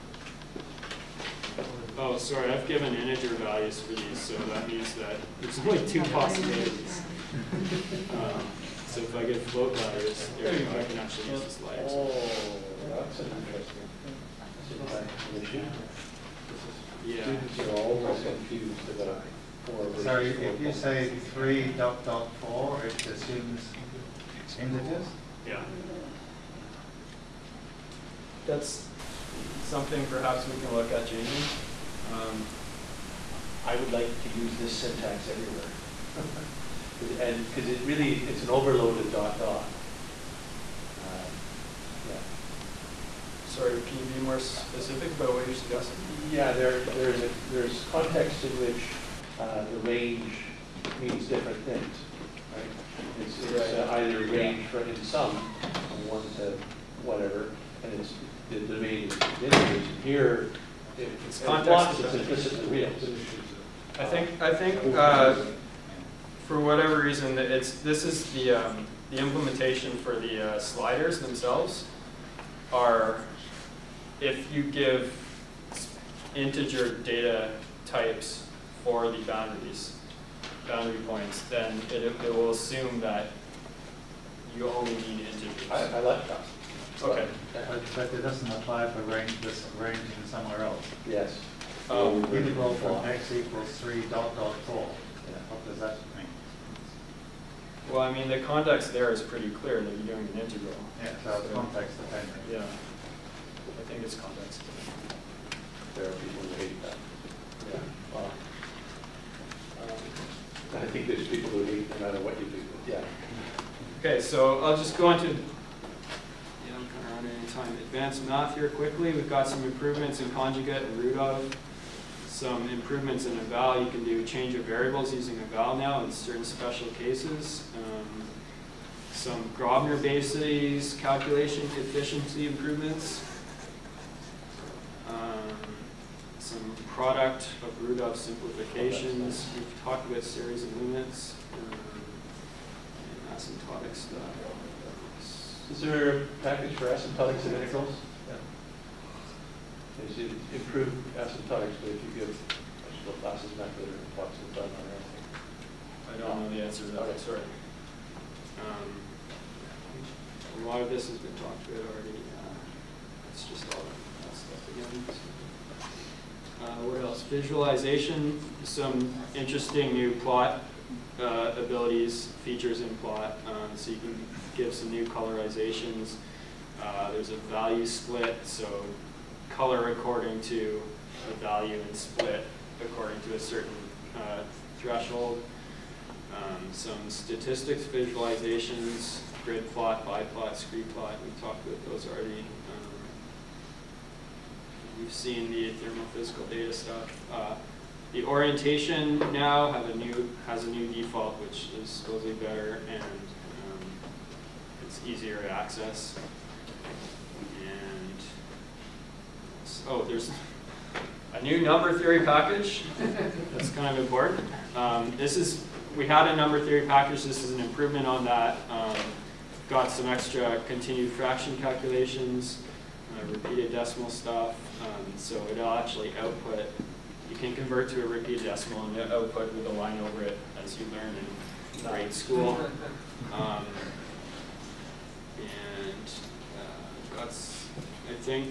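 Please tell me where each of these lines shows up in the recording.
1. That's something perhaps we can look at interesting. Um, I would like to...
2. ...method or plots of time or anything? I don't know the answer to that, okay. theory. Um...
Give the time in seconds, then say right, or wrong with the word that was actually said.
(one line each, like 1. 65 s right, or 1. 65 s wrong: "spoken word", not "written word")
1. 28 s wrong: "changing", not "interesting"
2. 153 s wrong: "sorry", not "theory".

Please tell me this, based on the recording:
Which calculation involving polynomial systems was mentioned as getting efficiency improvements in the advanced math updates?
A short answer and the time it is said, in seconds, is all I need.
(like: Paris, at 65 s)
Grobner bases, at 129 s.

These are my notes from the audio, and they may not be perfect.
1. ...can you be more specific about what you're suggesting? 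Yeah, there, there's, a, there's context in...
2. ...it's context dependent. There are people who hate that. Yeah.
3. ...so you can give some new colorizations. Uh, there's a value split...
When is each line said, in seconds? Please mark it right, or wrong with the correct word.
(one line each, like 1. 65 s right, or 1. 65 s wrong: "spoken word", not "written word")
1. 43 s right
2. 104 s right
3. 173 s right.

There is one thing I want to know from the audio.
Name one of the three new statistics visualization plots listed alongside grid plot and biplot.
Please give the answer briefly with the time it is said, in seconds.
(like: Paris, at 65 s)
scree plot, at 190 s.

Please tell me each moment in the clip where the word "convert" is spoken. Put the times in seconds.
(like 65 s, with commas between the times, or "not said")
227 s.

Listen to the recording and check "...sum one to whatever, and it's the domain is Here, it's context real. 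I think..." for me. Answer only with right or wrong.
right.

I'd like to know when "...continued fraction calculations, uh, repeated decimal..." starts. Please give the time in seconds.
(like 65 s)
220 s.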